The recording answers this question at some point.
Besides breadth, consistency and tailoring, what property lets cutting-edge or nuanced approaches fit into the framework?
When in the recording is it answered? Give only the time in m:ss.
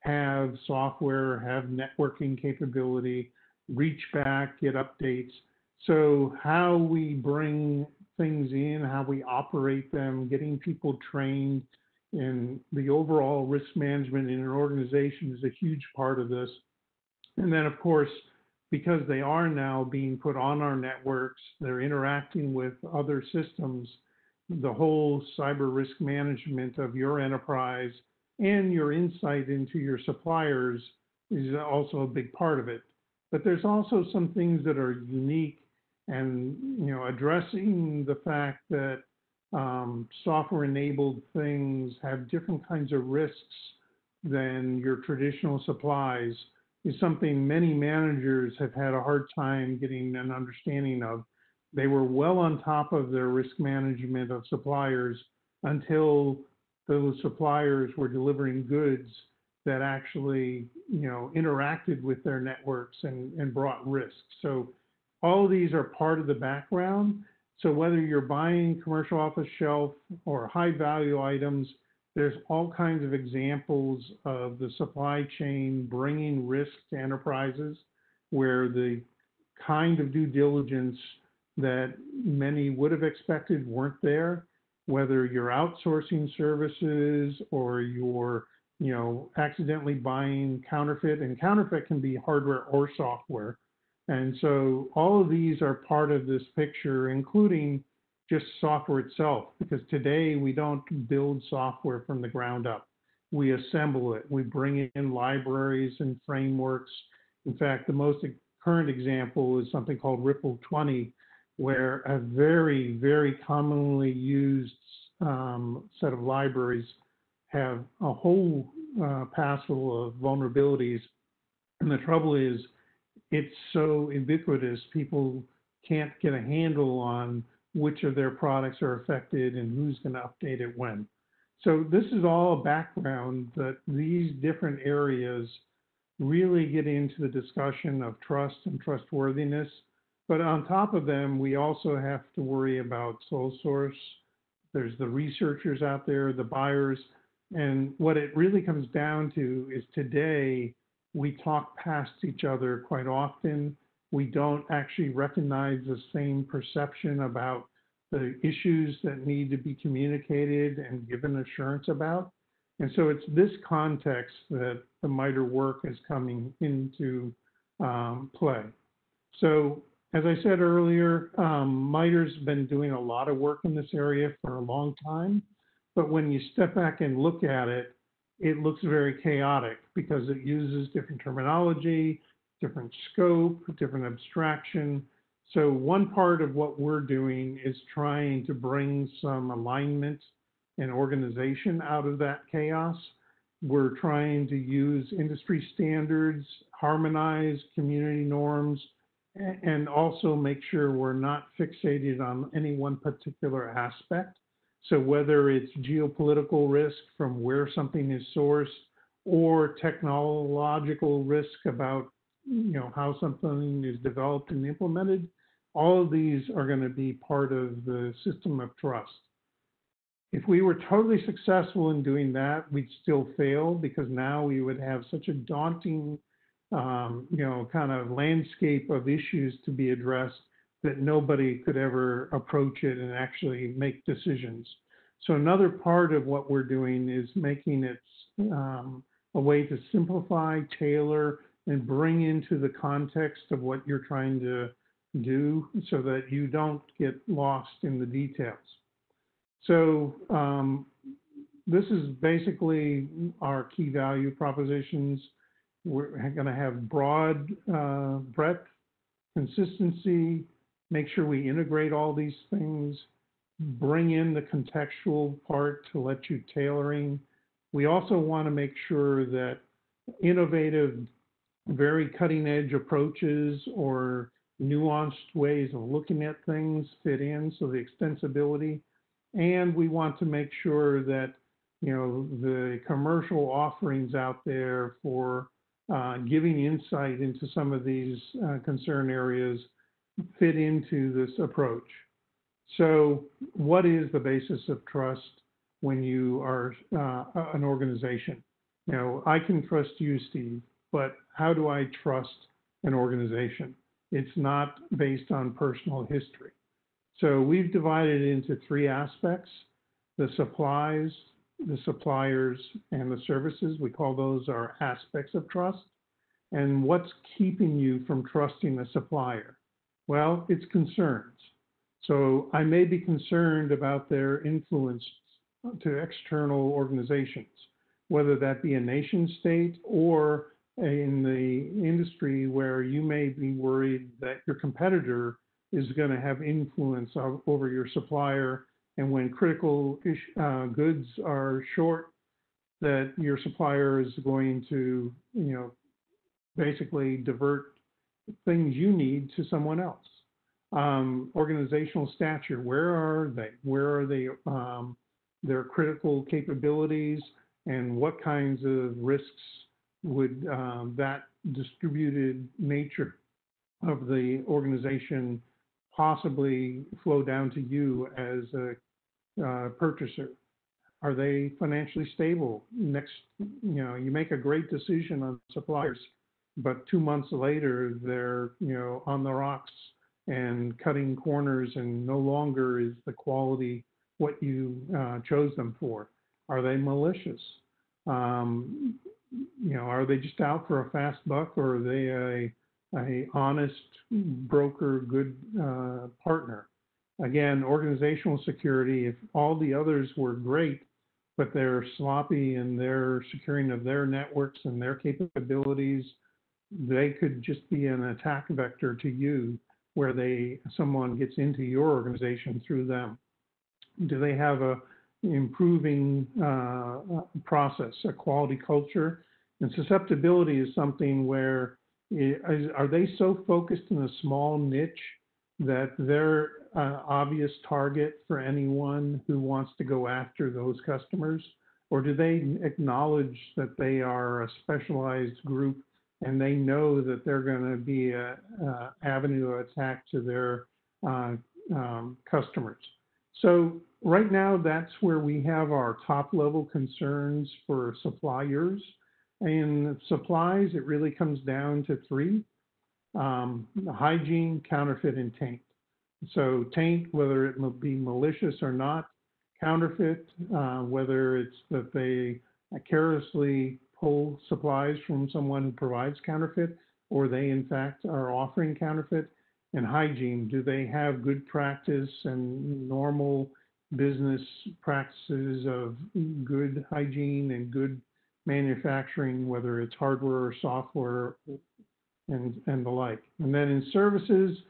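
4:37.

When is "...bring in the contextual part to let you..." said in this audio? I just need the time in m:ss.
4:23.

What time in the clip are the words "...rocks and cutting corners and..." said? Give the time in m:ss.
6:19.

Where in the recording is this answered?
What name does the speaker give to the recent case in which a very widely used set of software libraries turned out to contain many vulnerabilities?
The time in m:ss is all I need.
1:50.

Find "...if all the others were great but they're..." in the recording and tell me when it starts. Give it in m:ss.
6:39.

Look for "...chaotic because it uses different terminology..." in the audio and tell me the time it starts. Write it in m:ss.
2:59.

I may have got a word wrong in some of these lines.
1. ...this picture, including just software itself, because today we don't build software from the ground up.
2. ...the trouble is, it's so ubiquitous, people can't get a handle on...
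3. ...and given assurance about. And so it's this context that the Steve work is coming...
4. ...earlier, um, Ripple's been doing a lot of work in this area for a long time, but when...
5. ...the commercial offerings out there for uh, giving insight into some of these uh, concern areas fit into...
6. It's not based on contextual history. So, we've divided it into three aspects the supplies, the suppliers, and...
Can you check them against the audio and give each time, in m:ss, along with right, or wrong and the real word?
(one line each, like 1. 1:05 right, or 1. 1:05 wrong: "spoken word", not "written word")
1. 1:36 right
2. 2:01 right
3. 2:40 wrong: "MITRE", not "Steve"
4. 2:50 wrong: "MITRE", not "Ripple"
5. 4:42 right
6. 5:04 wrong: "personal", not "contextual".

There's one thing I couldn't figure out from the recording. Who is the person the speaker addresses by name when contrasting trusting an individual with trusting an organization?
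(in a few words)
Steve.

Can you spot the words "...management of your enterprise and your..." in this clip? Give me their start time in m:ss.
0:26.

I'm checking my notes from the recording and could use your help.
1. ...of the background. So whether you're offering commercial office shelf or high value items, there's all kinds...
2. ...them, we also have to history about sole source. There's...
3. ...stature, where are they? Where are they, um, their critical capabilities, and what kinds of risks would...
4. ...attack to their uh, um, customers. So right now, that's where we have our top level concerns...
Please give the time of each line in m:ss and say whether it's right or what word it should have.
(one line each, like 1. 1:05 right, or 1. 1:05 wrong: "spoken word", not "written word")
1. 1:06 wrong: "buying", not "offering"
2. 2:21 wrong: "worry", not "history"
3. 5:52 right
4. 7:19 right.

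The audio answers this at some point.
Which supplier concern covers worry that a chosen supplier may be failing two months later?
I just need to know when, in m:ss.
6:11.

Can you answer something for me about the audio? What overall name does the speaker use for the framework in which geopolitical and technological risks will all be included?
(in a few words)
system of trust.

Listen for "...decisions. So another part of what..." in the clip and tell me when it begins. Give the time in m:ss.
3:54.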